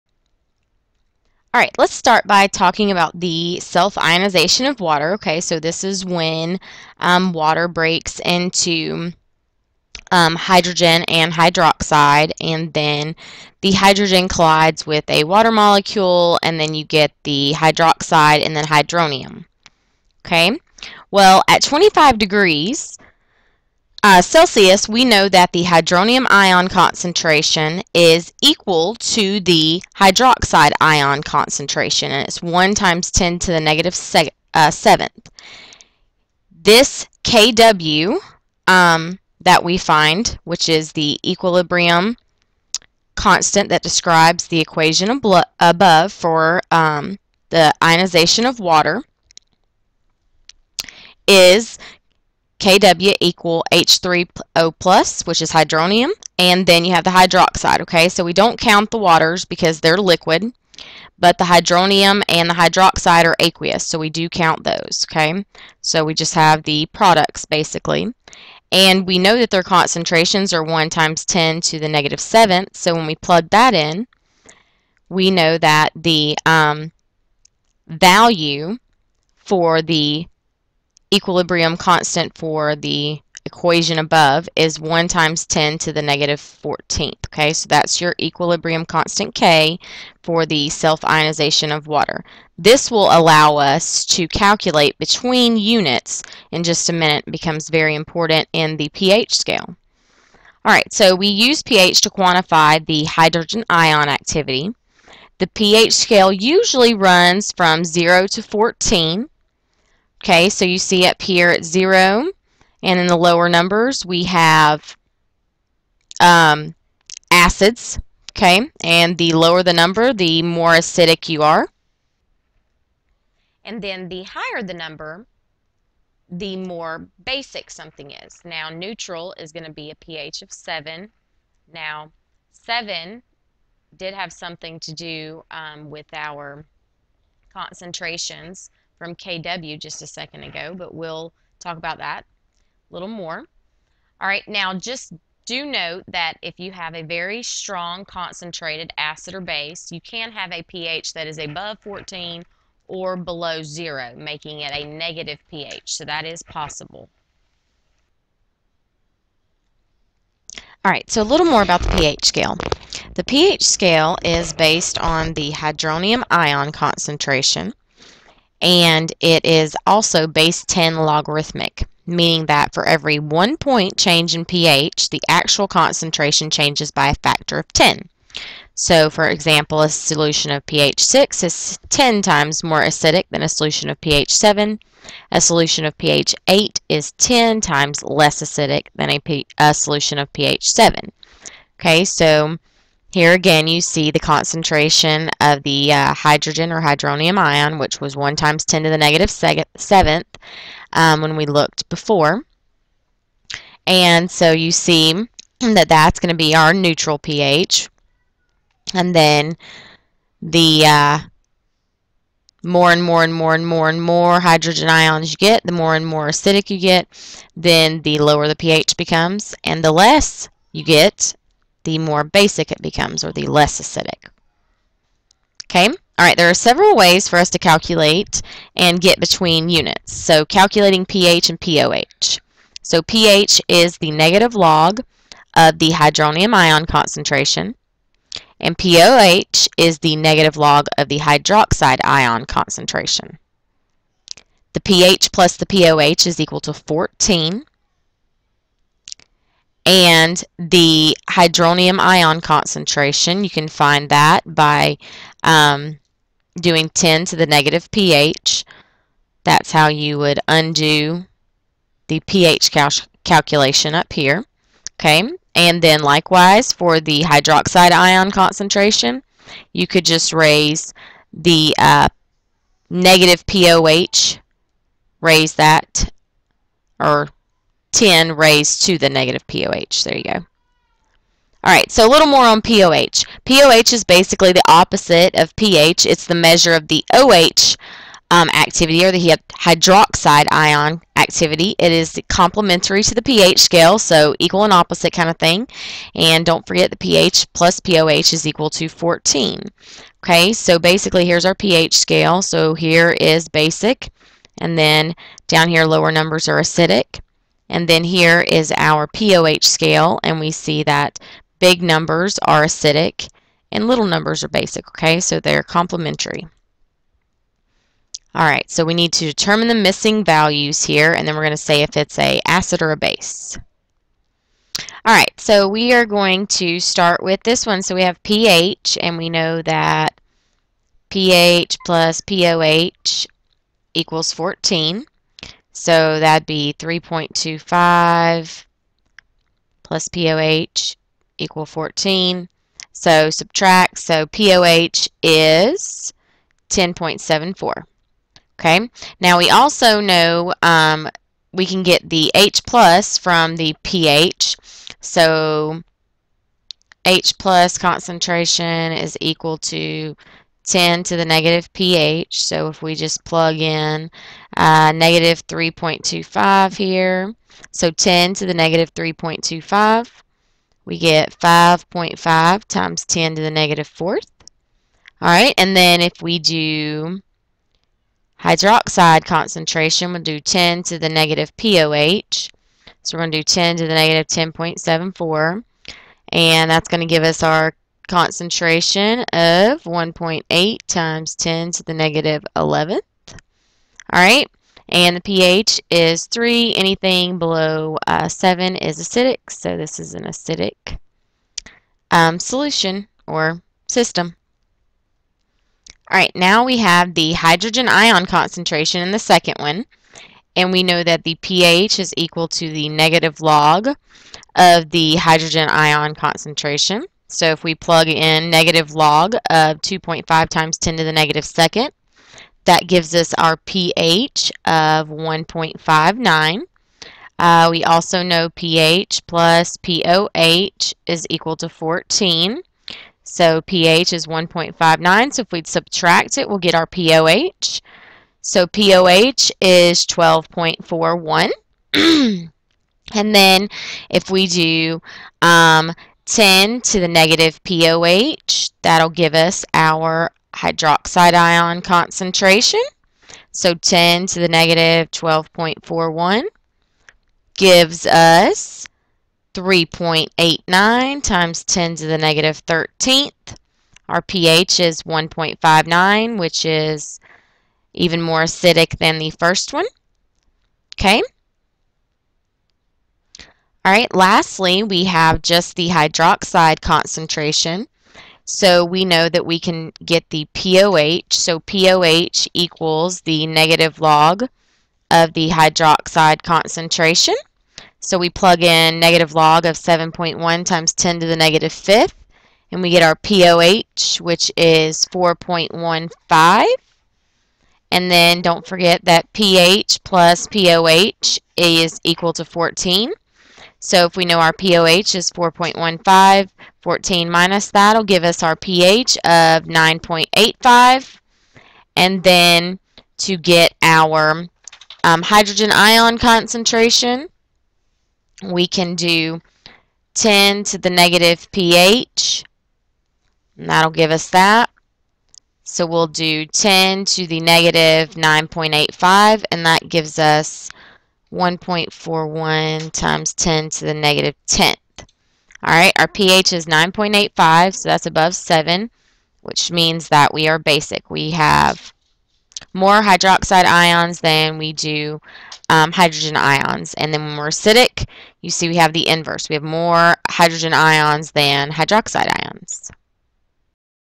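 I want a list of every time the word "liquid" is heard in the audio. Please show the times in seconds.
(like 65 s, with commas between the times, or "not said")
59 s.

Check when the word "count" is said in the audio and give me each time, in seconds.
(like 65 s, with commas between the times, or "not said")
58 s, 64 s.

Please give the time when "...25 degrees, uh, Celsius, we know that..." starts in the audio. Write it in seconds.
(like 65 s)
21 s.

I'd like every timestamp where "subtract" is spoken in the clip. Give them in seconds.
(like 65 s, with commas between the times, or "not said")
343 s, 435 s.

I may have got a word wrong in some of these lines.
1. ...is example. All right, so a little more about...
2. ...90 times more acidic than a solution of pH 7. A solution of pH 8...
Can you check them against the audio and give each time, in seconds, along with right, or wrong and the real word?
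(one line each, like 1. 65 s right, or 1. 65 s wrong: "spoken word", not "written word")
1. 156 s wrong: "possible", not "example"
2. 181 s wrong: "10", not "90".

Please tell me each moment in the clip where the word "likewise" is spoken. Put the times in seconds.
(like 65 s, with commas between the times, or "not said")
266 s.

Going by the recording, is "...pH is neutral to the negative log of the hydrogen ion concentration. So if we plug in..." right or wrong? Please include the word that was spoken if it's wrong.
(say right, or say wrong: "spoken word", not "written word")
wrong: "equal", not "neutral".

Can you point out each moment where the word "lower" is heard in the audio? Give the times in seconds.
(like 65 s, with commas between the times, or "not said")
113 s, 119 s, 218 s, 305 s.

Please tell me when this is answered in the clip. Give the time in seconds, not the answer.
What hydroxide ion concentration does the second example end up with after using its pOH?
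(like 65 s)
459 s.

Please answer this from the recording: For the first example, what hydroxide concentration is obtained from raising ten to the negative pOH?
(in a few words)
1.8 x 10^-11.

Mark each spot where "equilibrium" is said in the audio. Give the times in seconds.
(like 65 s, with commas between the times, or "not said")
41 s, 81 s, 88 s.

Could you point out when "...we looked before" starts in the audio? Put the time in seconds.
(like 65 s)
201 s.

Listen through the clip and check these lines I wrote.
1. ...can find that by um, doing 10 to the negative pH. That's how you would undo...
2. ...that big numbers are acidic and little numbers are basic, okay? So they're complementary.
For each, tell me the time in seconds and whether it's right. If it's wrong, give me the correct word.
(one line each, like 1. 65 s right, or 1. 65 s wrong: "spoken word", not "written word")
1. 253 s right
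2. 310 s right.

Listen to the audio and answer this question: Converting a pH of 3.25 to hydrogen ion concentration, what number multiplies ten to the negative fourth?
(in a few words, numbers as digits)
5.5.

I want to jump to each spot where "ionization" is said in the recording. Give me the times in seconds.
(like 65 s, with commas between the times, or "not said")
3 s, 47 s, 90 s.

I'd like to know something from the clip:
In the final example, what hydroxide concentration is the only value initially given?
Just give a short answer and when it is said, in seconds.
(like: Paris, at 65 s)
7.1 x 10^-5, at 489 s.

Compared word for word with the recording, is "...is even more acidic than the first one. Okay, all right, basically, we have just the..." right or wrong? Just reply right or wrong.
wrong.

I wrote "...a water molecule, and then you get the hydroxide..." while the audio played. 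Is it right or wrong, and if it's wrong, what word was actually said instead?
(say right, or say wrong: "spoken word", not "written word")
right.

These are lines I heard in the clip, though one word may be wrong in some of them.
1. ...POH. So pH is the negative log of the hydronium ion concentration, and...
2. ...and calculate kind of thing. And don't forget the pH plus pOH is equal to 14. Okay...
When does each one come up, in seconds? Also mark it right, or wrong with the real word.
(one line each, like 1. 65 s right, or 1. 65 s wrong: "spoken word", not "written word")
1. 231 s right
2. 294 s wrong: "opposite", not "calculate".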